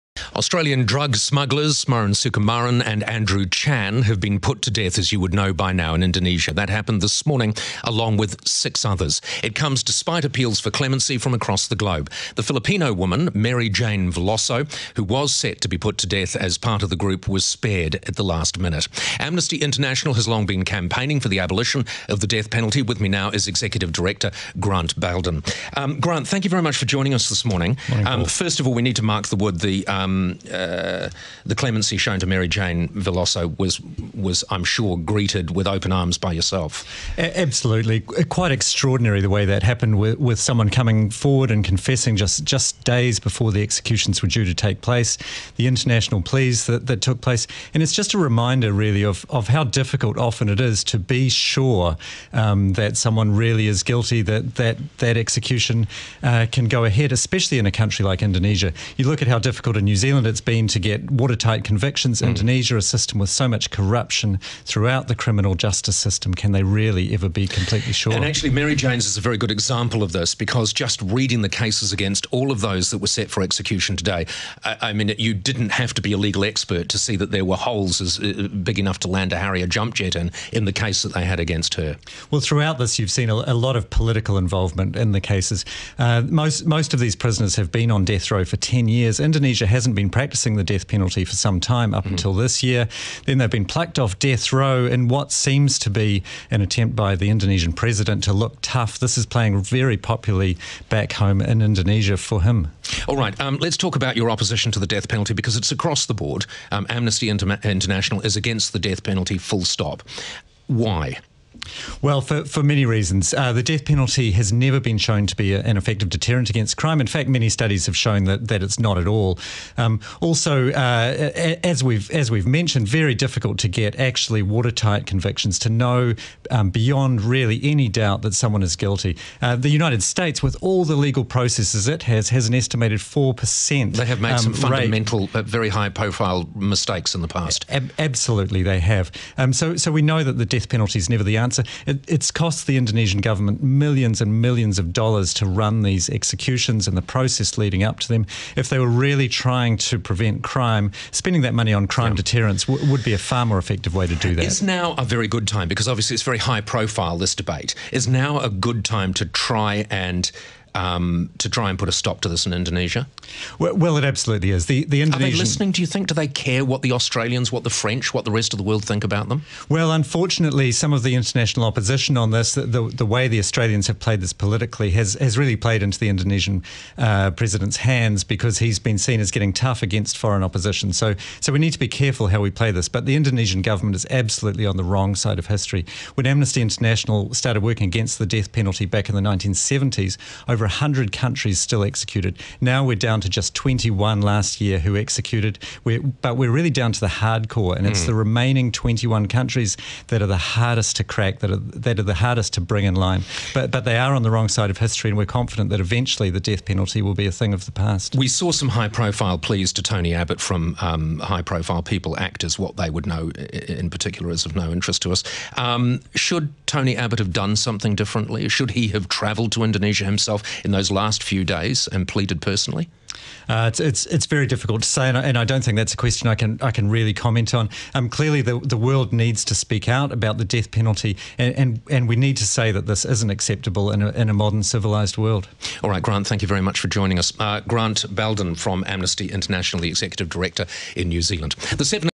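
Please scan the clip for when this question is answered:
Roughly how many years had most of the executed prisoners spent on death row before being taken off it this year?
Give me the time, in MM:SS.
01:28.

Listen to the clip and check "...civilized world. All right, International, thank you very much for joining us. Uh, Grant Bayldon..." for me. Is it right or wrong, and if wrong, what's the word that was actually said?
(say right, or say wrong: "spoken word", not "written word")
wrong: "Grant", not "International".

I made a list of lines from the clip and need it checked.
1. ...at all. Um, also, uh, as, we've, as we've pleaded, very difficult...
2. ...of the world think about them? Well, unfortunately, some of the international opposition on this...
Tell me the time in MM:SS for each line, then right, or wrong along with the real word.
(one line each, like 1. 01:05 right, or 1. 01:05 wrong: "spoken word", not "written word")
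1. 01:58 wrong: "mentioned", not "pleaded"
2. 02:48 right.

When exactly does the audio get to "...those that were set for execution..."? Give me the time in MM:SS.
01:12.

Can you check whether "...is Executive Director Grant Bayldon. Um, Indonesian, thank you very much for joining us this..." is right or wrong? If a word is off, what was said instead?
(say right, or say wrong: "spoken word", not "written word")
wrong: "Grant", not "Indonesian".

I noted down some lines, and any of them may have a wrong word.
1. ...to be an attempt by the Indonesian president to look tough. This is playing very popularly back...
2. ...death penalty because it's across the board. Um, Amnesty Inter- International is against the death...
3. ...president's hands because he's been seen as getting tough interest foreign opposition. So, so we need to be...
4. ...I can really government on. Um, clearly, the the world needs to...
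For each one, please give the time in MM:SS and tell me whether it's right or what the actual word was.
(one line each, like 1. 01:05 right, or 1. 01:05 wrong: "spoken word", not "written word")
1. 01:35 right
2. 01:44 right
3. 02:57 wrong: "against", not "interest"
4. 03:46 wrong: "comment", not "government".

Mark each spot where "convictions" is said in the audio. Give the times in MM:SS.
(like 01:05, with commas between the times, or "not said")
01:01, 02:05.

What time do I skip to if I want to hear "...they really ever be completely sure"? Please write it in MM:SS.
01:06.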